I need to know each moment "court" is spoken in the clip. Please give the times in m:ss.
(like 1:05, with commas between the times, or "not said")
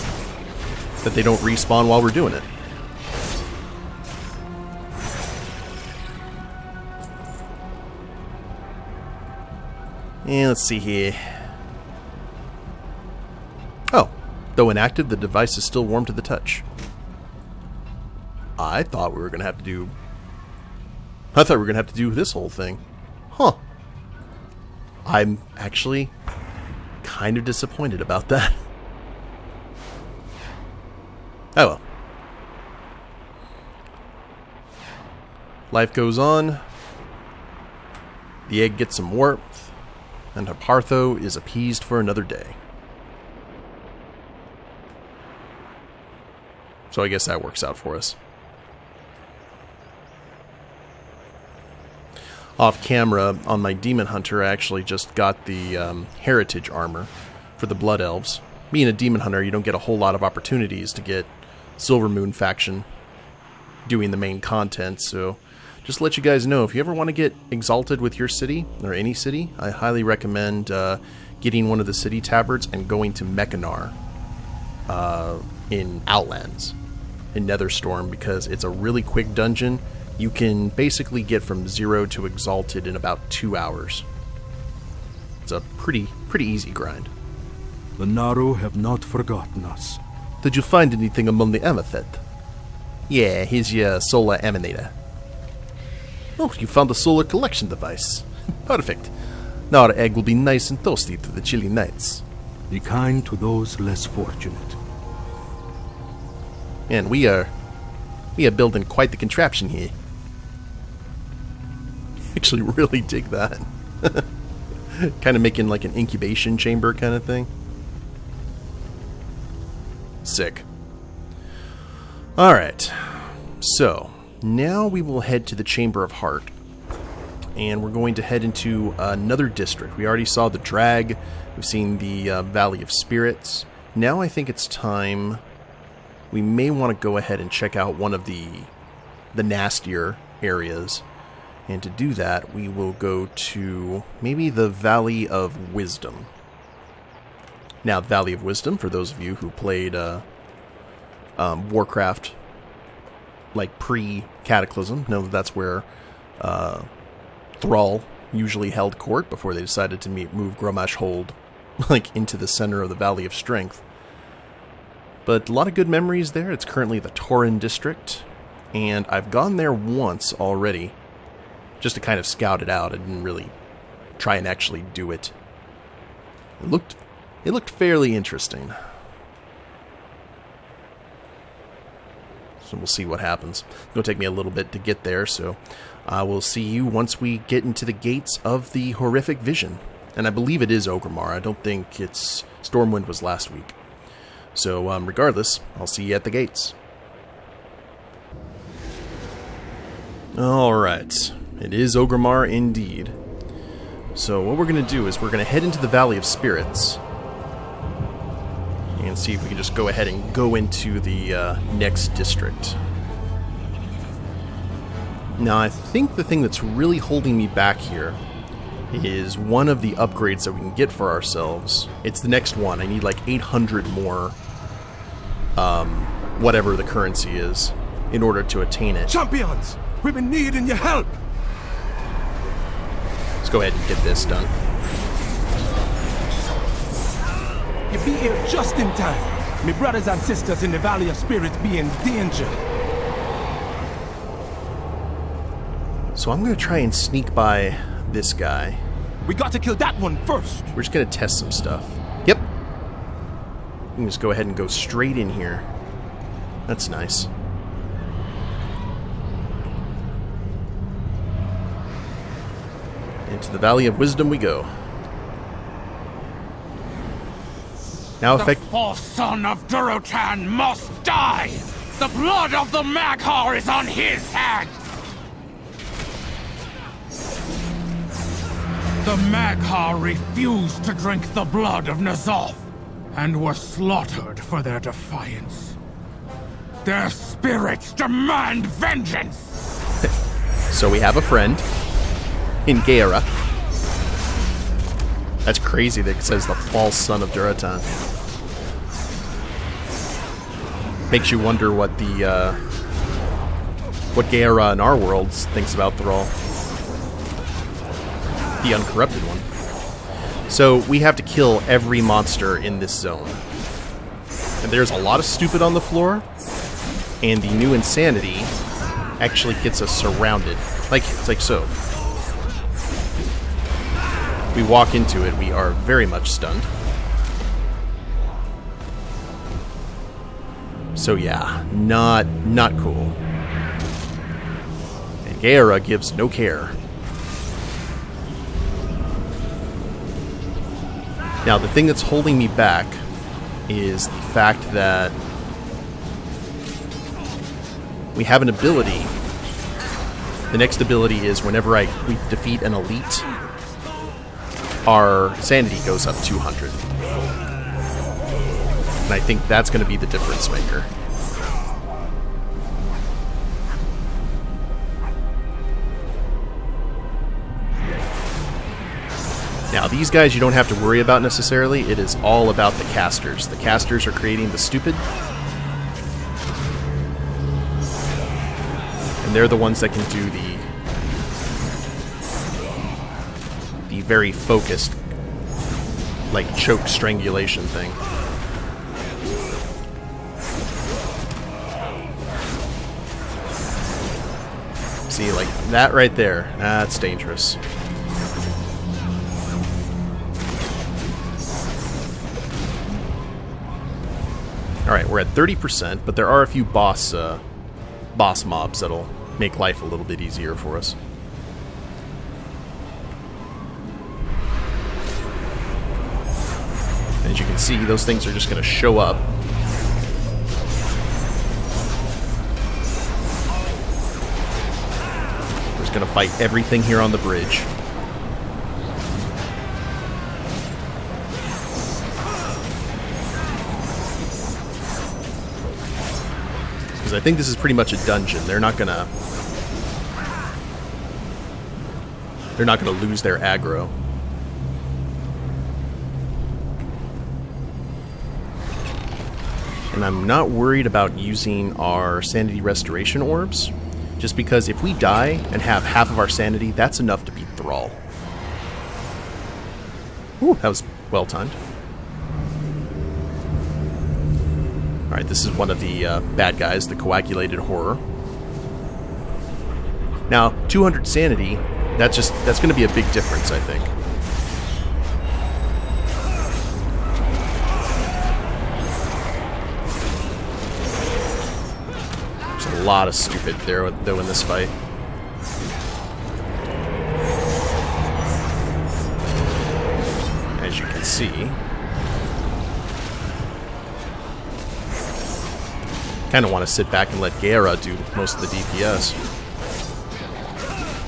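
2:38.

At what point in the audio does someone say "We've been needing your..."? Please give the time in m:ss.
3:50.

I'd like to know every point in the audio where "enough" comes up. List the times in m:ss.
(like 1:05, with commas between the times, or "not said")
7:36.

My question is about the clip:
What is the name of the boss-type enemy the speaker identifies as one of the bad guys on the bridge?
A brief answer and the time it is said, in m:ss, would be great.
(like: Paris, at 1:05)
coagulated horror, at 7:46.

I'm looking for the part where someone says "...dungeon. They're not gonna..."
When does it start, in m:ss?
7:18.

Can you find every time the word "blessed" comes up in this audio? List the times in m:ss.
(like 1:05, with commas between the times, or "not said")
not said.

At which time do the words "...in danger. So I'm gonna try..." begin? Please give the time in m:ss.
4:01.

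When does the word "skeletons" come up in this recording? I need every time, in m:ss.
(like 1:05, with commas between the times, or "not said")
not said.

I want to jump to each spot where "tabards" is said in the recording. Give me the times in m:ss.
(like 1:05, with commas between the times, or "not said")
1:12.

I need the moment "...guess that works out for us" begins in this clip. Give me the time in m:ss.
0:47.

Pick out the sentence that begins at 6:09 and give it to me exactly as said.
Now, these guys you don't have to worry about necessarily.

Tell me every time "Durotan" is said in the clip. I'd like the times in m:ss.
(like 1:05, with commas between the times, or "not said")
4:29, 4:57.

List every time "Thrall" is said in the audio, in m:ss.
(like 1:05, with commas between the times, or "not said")
2:37, 5:05, 7:37.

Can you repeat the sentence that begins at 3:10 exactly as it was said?
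And I believe it is Orgrimmar.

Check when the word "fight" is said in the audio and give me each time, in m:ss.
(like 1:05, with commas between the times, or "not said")
7:06, 8:04.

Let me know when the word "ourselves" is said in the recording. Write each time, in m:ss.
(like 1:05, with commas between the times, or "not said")
3:41.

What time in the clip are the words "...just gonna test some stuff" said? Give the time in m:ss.
4:10.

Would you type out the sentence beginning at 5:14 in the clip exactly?
And there's a lot of stupid on the floor, and the new insanity actually gets us surrounded.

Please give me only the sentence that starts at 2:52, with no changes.
I didn't really try and actually do it.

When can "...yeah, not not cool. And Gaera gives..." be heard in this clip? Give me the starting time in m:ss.
5:31.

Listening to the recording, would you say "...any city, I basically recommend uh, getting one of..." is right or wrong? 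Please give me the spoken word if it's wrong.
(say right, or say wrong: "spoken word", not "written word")
wrong: "highly", not "basically".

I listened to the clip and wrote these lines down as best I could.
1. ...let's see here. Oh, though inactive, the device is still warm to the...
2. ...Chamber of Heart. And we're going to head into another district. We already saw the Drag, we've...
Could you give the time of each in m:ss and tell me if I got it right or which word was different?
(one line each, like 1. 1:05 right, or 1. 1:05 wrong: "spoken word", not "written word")
1. 0:10 right
2. 2:05 right.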